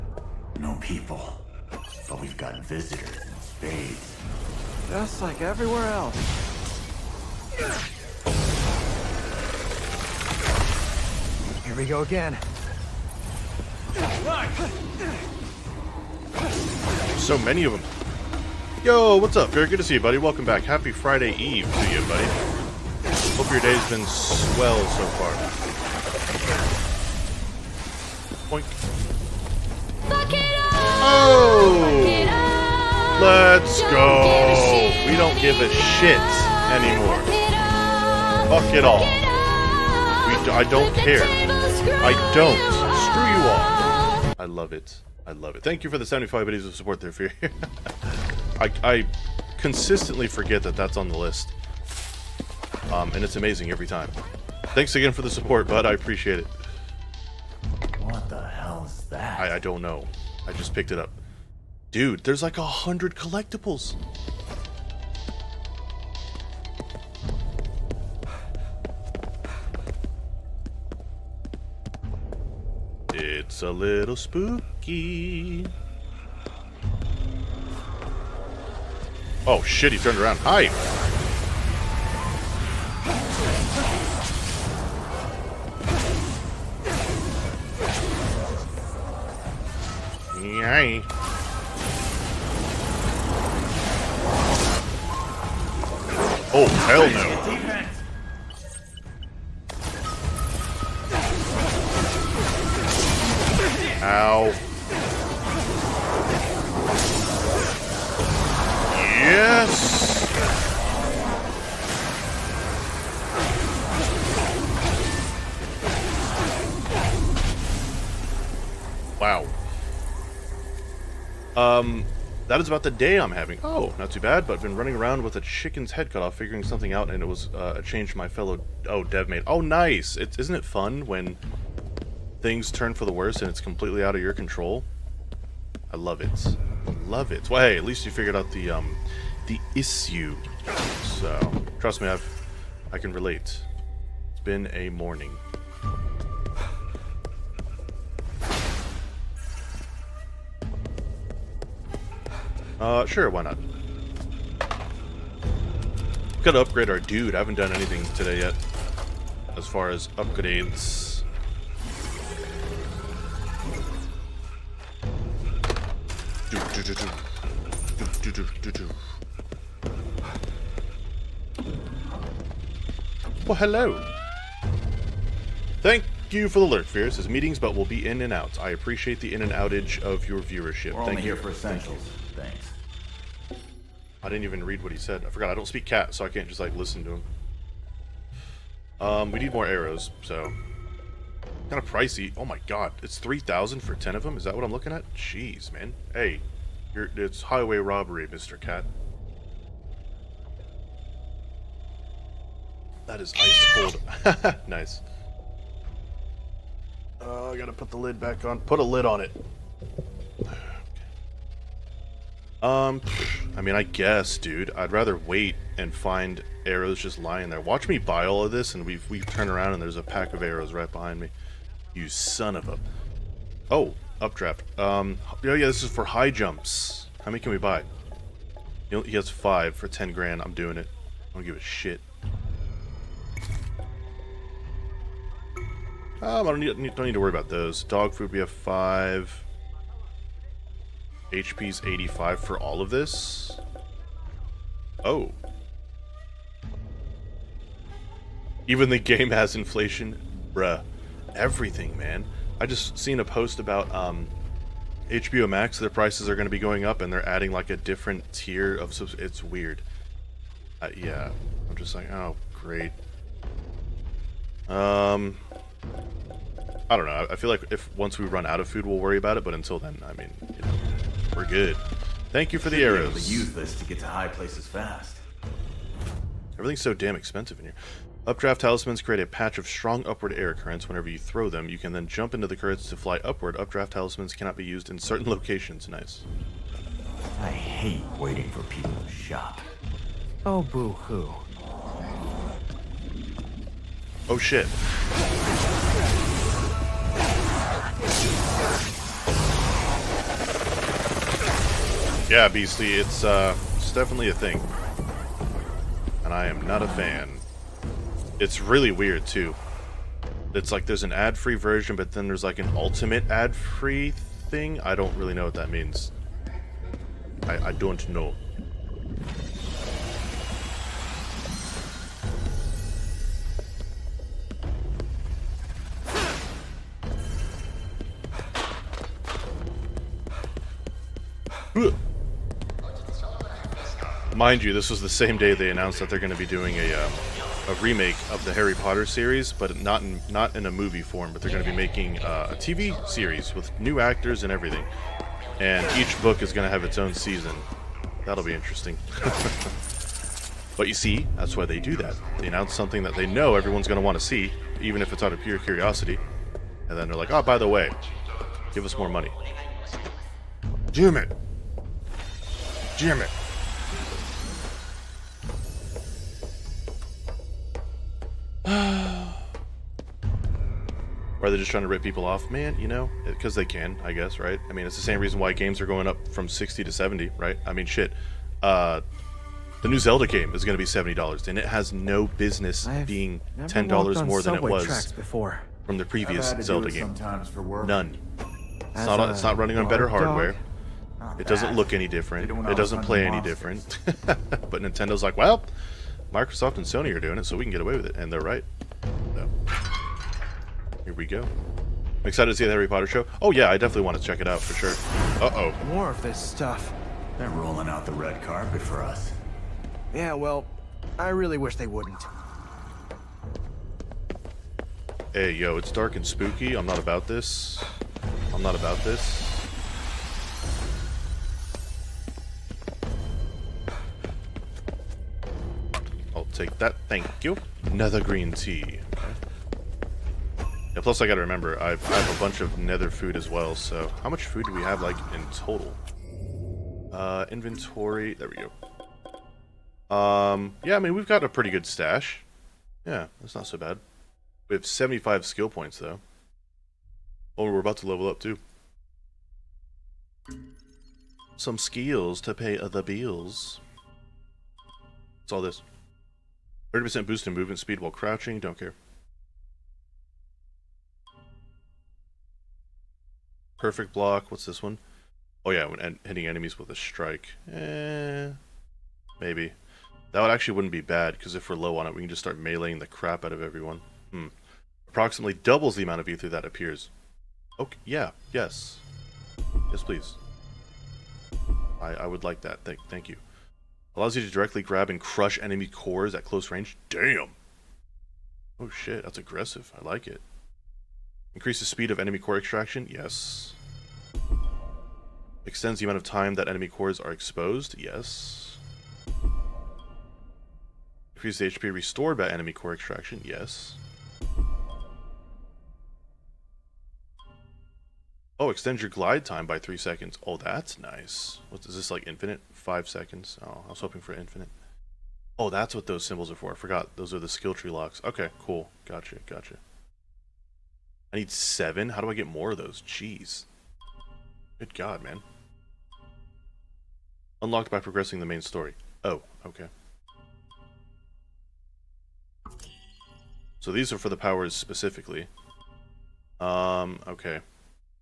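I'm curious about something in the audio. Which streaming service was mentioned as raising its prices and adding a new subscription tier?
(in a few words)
HBO Max.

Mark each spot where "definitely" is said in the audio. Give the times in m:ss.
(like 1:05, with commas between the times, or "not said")
5:03, 6:43.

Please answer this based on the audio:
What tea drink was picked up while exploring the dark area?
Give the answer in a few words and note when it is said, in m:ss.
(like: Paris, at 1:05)
Nether green tea, at 7:07.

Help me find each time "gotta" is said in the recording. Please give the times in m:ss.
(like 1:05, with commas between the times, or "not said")
3:27, 7:11.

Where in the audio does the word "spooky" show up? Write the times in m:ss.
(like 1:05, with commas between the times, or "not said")
1:14, 6:56.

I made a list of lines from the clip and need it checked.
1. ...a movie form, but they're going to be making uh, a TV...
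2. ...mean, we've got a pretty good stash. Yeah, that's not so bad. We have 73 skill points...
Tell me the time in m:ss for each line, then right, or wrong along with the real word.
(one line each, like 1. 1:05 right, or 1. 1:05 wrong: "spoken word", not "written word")
1. 5:40 right
2. 7:20 wrong: "75", not "73".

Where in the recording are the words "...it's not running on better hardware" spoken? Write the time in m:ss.
6:29.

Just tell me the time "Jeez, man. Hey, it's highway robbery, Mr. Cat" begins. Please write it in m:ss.
3:15.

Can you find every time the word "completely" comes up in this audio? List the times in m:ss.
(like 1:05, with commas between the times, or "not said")
2:13.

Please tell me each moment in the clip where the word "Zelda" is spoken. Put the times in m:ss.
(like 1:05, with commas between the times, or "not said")
6:19, 6:26.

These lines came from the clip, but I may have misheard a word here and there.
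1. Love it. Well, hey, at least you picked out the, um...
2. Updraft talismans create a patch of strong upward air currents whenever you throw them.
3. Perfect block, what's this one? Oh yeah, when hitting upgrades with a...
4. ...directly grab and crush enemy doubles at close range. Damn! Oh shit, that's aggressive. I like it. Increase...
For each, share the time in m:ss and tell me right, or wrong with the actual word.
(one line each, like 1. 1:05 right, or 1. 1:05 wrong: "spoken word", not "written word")
1. 2:17 wrong: "figured", not "picked"
2. 4:38 right
3. 7:43 wrong: "enemies", not "upgrades"
4. 8:04 wrong: "cores", not "doubles".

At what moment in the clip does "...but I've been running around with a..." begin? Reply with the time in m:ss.
2:04.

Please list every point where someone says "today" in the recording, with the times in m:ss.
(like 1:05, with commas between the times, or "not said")
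2:38.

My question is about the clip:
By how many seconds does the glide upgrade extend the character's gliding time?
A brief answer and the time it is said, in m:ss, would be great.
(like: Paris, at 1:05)
3, at 8:29.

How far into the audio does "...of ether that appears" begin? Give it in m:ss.
7:56.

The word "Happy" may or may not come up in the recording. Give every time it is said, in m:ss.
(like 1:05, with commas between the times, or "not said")
0:20.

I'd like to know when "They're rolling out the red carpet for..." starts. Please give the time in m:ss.
6:47.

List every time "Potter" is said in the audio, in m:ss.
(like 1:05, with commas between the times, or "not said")
5:38, 6:42.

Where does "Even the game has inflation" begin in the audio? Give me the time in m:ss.
4:08.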